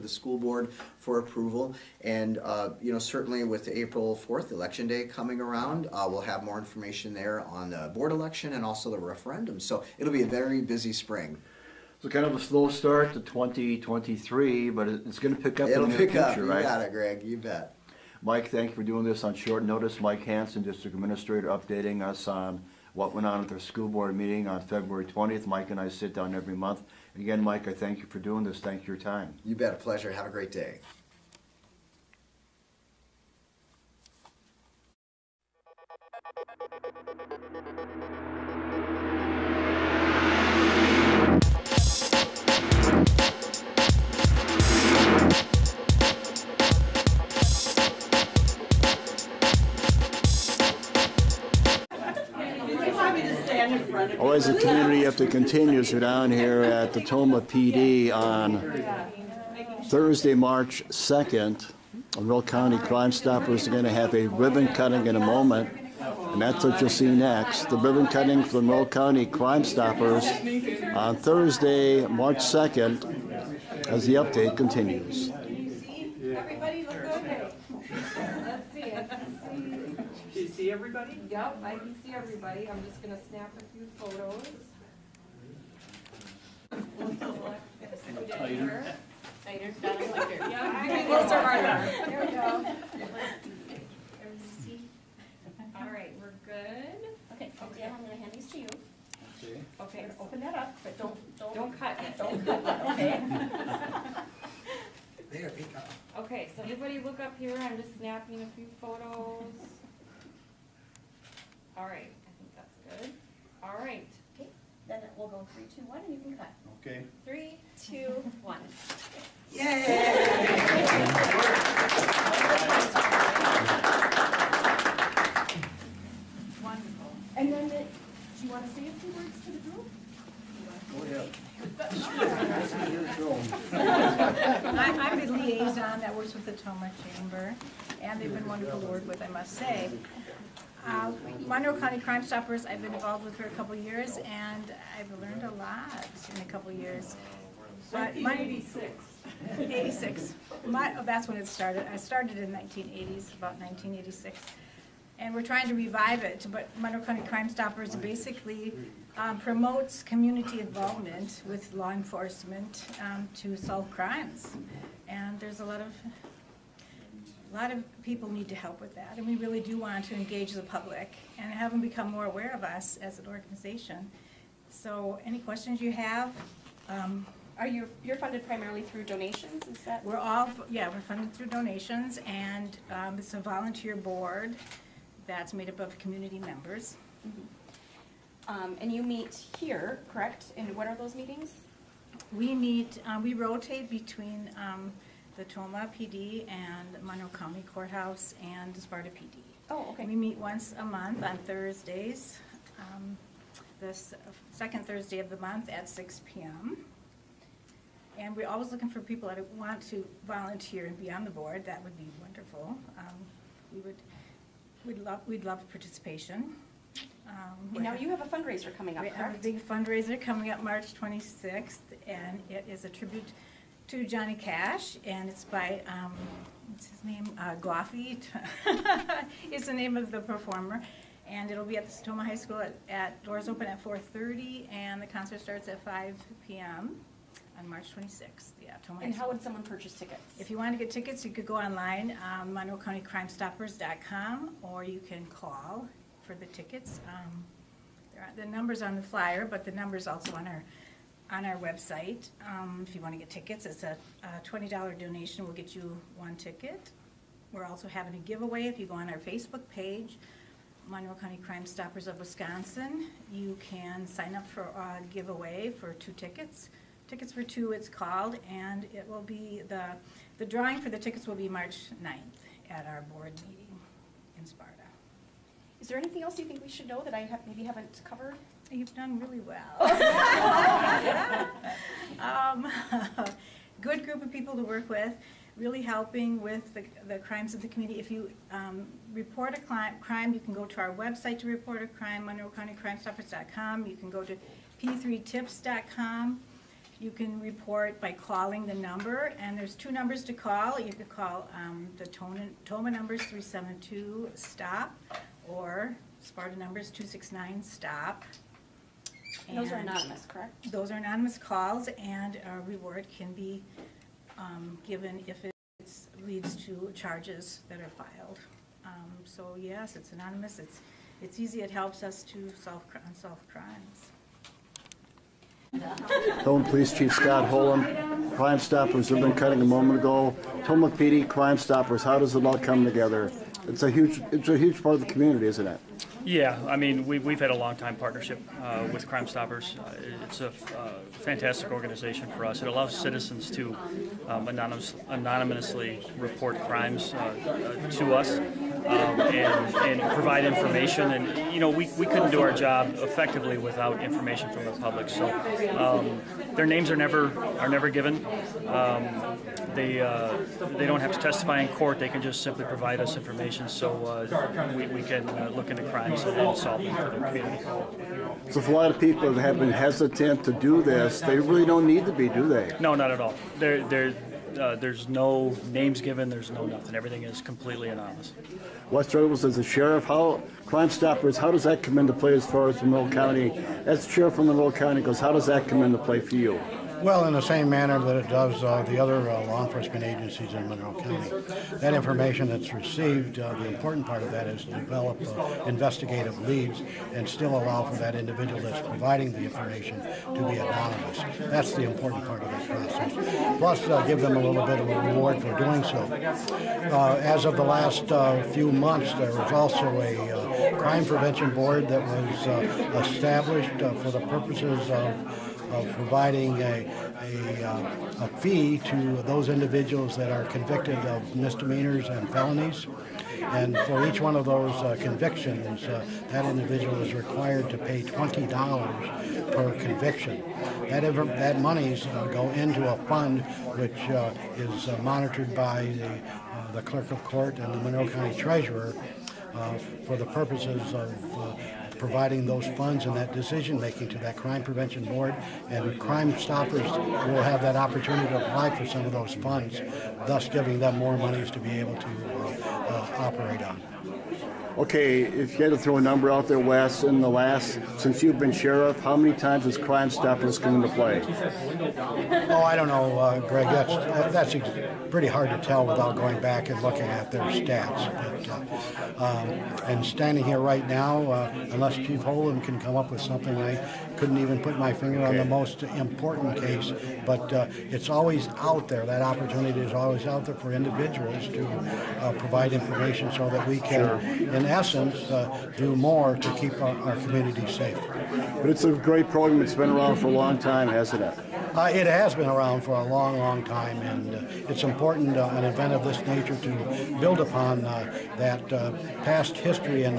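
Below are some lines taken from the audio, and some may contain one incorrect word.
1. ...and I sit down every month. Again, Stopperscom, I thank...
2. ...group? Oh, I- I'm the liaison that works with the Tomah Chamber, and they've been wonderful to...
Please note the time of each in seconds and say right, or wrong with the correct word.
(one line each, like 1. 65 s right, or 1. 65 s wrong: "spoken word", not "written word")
1. 25 s wrong: "Mike", not "Stopperscom"
2. 129 s right.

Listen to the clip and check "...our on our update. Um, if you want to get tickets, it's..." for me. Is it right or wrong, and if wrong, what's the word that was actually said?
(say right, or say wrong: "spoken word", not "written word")
wrong: "website", not "update".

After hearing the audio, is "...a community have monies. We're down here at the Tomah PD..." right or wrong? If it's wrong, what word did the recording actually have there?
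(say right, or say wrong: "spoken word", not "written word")
wrong: "continues", not "monies".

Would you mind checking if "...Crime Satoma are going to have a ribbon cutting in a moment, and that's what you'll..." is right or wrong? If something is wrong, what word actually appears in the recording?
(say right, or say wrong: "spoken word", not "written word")
wrong: "Stoppers", not "Satoma".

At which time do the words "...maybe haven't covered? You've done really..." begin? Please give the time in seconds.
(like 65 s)
277 s.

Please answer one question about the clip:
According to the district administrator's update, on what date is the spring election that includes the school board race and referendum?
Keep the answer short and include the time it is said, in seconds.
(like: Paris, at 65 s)
April 4th, at 3 s.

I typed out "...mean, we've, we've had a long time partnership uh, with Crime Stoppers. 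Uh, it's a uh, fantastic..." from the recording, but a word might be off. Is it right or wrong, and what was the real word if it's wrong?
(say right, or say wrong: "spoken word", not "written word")
right.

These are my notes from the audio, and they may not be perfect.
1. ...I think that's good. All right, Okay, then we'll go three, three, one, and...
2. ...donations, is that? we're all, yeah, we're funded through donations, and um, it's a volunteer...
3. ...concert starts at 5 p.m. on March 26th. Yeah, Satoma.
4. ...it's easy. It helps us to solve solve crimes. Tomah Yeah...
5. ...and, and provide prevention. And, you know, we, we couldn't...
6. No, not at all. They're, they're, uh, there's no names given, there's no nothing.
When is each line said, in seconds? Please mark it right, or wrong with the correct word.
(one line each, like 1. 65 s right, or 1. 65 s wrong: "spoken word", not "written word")
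1. 112 s wrong: "two", not "three"
2. 179 s right
3. 235 s right
4. 321 s wrong: "Police", not "Yeah"
5. 349 s wrong: "information", not "prevention"
6. 372 s right.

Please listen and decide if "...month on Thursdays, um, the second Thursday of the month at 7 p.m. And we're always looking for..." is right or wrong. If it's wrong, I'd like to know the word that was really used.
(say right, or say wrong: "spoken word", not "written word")
wrong: "6", not "7".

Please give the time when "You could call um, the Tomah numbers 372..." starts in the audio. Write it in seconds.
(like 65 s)
300 s.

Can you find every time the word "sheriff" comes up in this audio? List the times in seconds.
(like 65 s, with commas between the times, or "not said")
379 s, 384 s, 458 s.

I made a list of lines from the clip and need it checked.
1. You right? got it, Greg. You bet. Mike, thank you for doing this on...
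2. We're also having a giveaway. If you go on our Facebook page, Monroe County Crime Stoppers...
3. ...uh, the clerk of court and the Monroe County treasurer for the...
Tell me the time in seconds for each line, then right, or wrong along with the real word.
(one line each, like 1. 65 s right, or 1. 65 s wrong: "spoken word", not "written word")
1. 16 s right
2. 257 s right
3. 436 s right.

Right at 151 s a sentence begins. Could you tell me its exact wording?
I started in 1980s, about 1986.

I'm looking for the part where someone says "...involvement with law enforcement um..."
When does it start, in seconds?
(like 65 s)
160 s.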